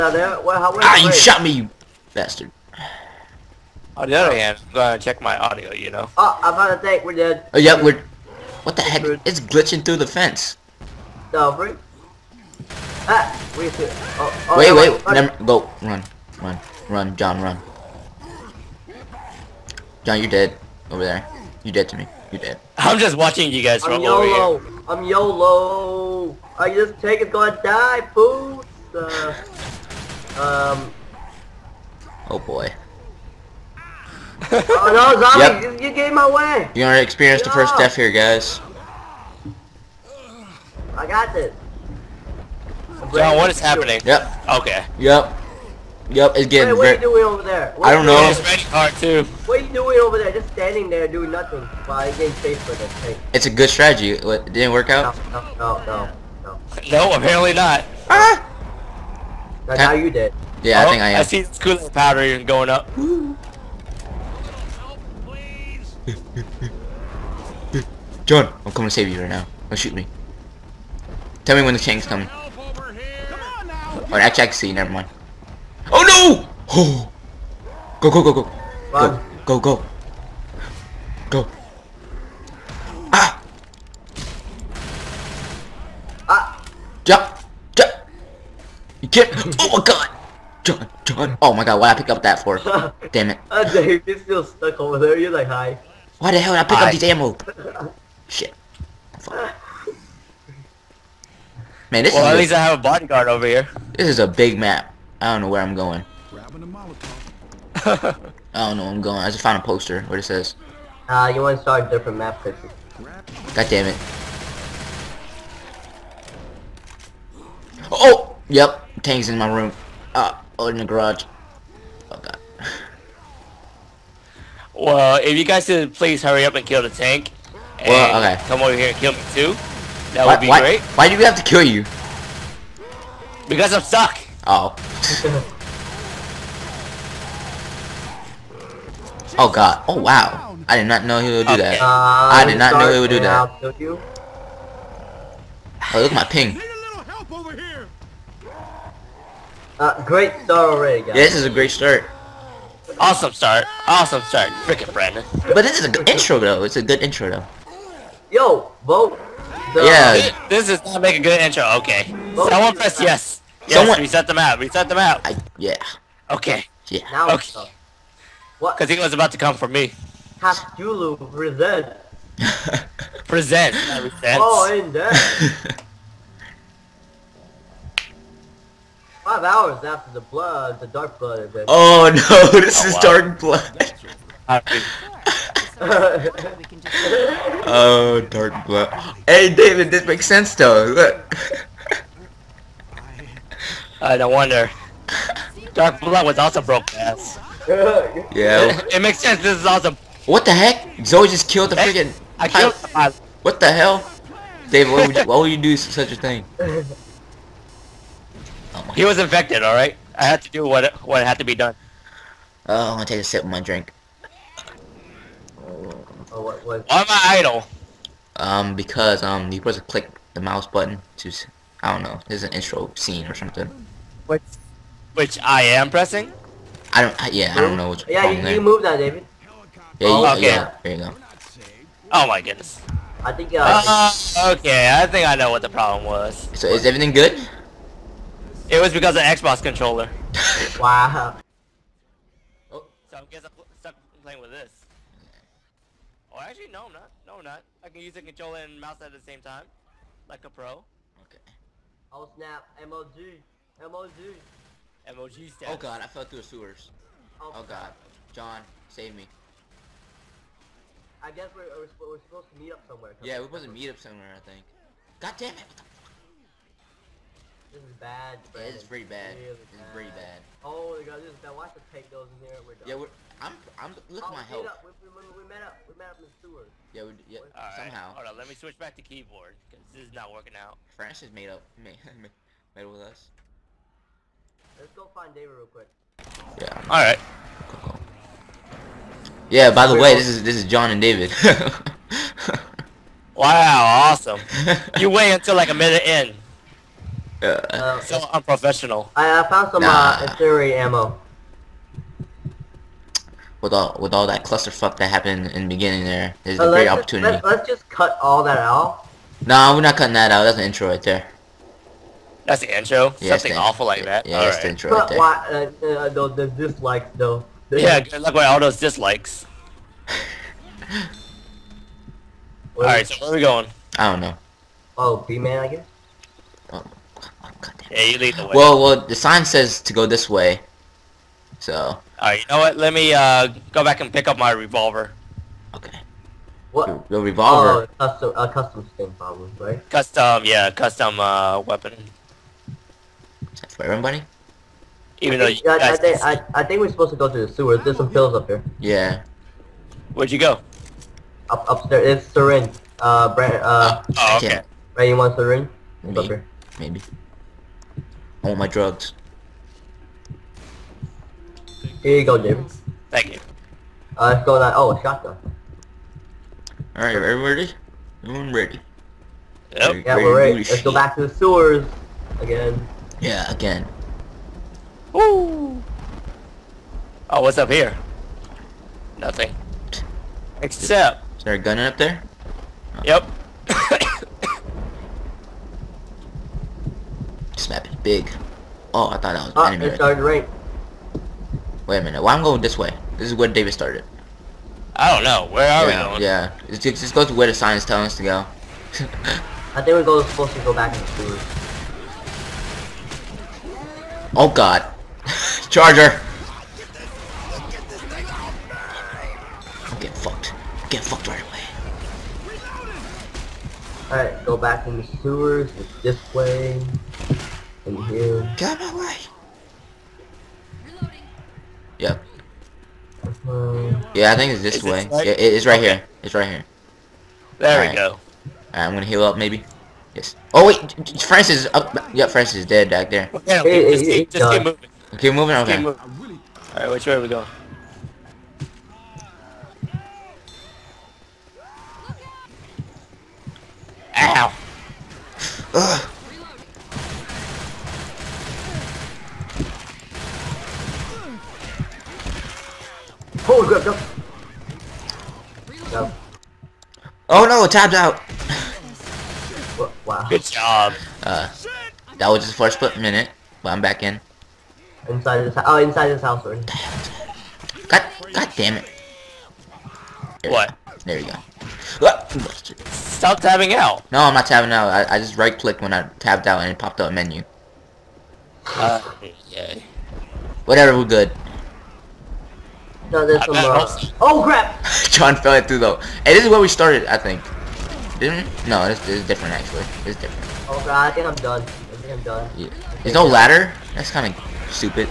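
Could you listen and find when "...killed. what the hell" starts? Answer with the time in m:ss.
3:22.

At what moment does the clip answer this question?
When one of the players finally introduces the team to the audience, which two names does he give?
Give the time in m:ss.
4:50.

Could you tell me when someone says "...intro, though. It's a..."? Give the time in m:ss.
2:36.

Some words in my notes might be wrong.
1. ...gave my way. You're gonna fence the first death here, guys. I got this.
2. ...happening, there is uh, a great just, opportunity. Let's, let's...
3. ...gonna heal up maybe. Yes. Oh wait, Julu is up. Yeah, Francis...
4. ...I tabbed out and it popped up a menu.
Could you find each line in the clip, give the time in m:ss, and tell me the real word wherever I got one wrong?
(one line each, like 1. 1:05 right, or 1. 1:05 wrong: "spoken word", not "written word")
1. 0:35 wrong: "experience", not "fence"
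2. 5:05 wrong: "beginning", not "happening"
3. 7:08 wrong: "Francis", not "Julu"
4. 7:55 right.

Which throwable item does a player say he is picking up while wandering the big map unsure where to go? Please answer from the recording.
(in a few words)
Molotov.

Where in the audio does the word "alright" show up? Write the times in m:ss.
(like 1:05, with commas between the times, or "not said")
3:29, 6:54.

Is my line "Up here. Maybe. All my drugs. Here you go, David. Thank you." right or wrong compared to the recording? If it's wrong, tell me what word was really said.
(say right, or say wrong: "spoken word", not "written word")
right.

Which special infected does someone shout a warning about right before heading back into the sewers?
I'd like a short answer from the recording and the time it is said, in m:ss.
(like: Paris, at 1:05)
Charger, at 6:45.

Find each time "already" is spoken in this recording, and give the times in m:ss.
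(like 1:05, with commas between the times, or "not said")
2:30, 7:46.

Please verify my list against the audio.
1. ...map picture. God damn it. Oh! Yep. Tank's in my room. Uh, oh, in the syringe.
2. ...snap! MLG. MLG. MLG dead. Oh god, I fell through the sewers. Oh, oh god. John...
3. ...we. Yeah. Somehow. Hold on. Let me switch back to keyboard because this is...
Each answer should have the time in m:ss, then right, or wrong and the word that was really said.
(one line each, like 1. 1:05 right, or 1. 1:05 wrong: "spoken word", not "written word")
1. 1:52 wrong: "garage", not "syringe"
2. 4:12 right
3. 4:37 right.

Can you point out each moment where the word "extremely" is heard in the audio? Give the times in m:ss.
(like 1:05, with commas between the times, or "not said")
not said.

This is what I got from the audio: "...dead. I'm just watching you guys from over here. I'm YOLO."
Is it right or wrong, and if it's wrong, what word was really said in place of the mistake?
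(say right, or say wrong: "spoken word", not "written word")
right.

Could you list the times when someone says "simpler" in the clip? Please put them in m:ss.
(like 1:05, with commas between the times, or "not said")
not said.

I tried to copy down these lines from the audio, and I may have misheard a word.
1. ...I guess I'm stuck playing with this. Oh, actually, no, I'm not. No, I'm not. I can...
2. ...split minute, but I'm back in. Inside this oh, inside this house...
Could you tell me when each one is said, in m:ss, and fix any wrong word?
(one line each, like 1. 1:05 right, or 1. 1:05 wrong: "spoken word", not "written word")
1. 4:03 right
2. 7:42 right.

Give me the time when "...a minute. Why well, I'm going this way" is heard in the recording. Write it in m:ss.
6:31.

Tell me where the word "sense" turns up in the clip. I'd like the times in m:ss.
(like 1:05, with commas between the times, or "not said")
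3:10, 3:19.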